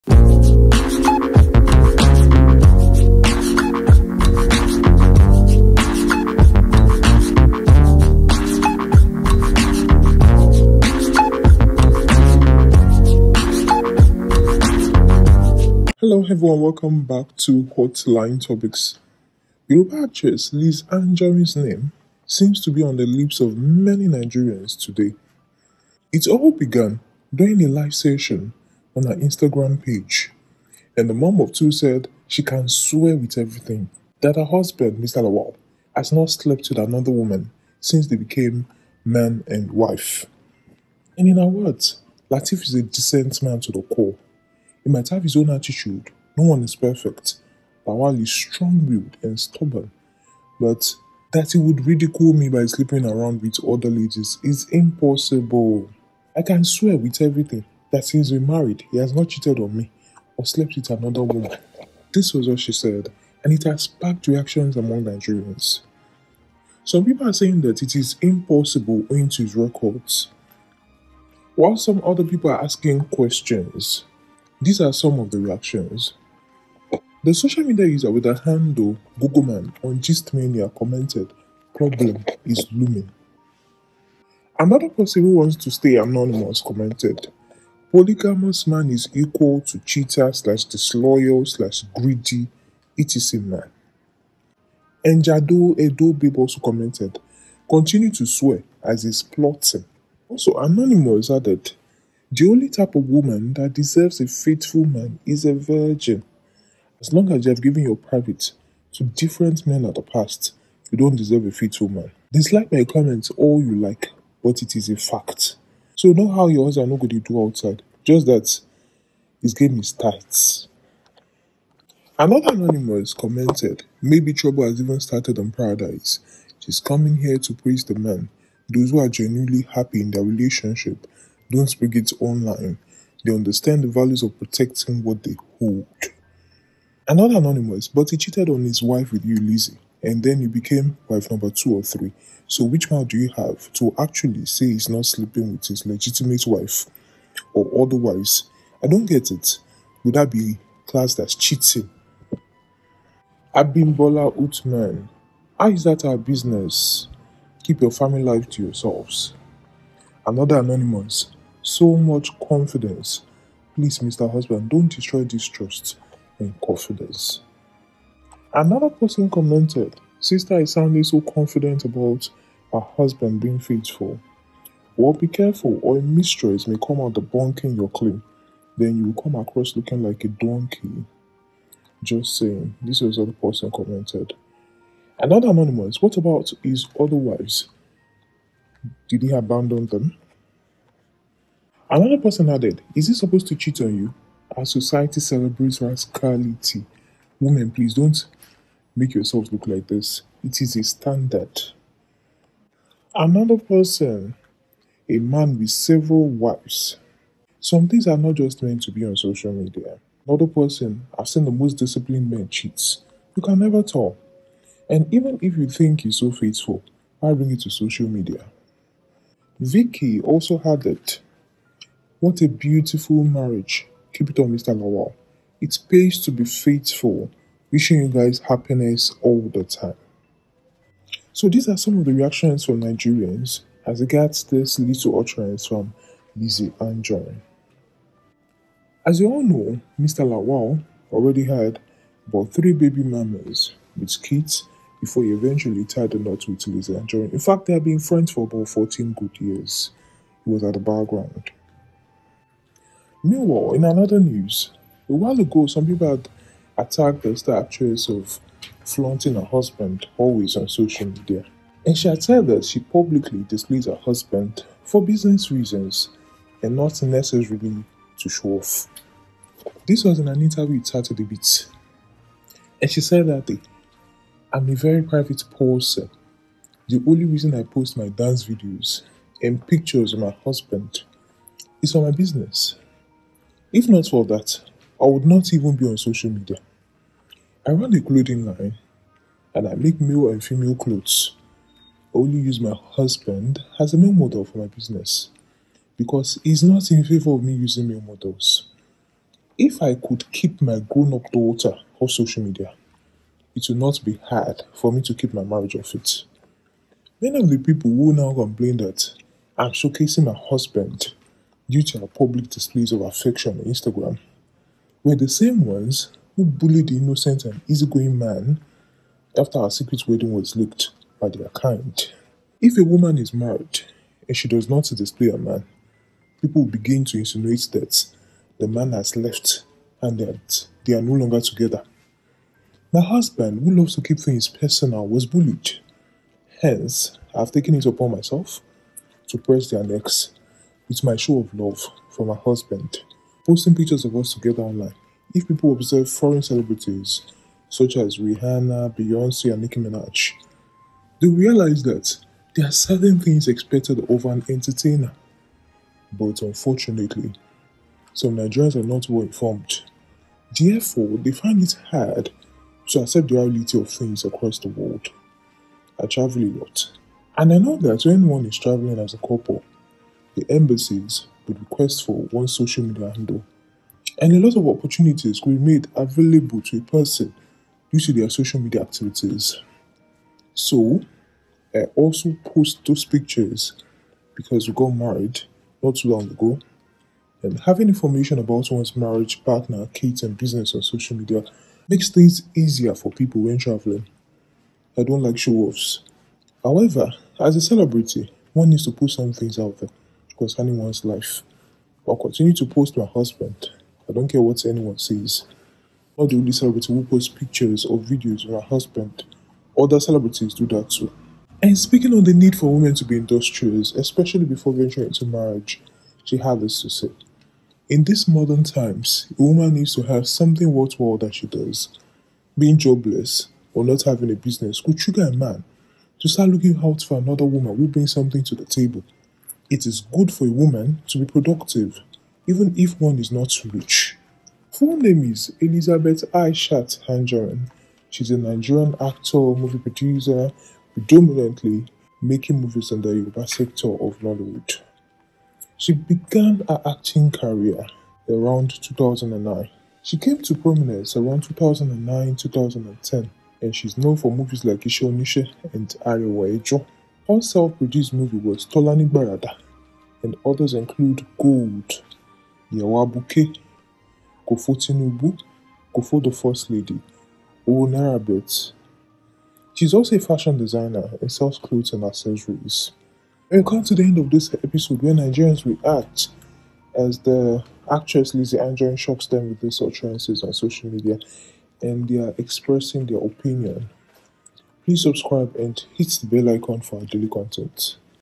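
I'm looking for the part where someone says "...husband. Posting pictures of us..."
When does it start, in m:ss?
5:42.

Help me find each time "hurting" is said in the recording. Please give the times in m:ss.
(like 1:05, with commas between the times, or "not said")
not said.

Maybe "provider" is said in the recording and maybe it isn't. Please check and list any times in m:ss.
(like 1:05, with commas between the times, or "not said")
not said.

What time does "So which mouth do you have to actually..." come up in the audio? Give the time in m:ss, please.
2:22.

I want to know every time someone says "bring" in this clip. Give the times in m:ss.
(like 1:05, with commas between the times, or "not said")
3:37, 7:07.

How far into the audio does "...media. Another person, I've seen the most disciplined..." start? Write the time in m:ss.
3:29.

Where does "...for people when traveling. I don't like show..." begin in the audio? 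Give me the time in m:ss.
6:32.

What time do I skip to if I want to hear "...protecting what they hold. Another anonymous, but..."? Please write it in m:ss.
2:14.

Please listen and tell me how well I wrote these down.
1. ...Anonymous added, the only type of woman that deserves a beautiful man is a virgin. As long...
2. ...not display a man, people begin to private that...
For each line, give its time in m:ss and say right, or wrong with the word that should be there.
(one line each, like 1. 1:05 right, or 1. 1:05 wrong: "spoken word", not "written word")
1. 1:40 wrong: "faithful", not "beautiful"
2. 5:24 wrong: "insinuate", not "private".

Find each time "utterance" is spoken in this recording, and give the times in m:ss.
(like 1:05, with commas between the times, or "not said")
3:55, 7:59.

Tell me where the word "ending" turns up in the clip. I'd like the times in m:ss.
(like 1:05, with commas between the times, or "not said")
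not said.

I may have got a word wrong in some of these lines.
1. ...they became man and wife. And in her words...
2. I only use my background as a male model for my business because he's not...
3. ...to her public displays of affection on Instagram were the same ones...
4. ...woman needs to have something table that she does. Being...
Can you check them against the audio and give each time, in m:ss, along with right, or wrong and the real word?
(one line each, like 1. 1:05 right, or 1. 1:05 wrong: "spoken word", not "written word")
1. 0:38 right
2. 4:52 wrong: "husband", not "background"
3. 5:11 right
4. 6:59 wrong: "worthwhile", not "table".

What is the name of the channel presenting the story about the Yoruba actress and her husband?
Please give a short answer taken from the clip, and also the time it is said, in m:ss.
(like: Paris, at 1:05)
Hotline Topics, at 0:17.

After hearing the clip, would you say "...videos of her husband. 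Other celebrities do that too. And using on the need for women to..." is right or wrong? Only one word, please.
wrong.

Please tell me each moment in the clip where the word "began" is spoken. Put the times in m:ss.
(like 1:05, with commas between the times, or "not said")
0:26, 7:25.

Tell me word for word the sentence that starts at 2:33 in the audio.
Abimbola Utman, how is that our business?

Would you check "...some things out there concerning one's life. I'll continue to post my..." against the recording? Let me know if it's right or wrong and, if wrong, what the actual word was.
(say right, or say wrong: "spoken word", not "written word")
right.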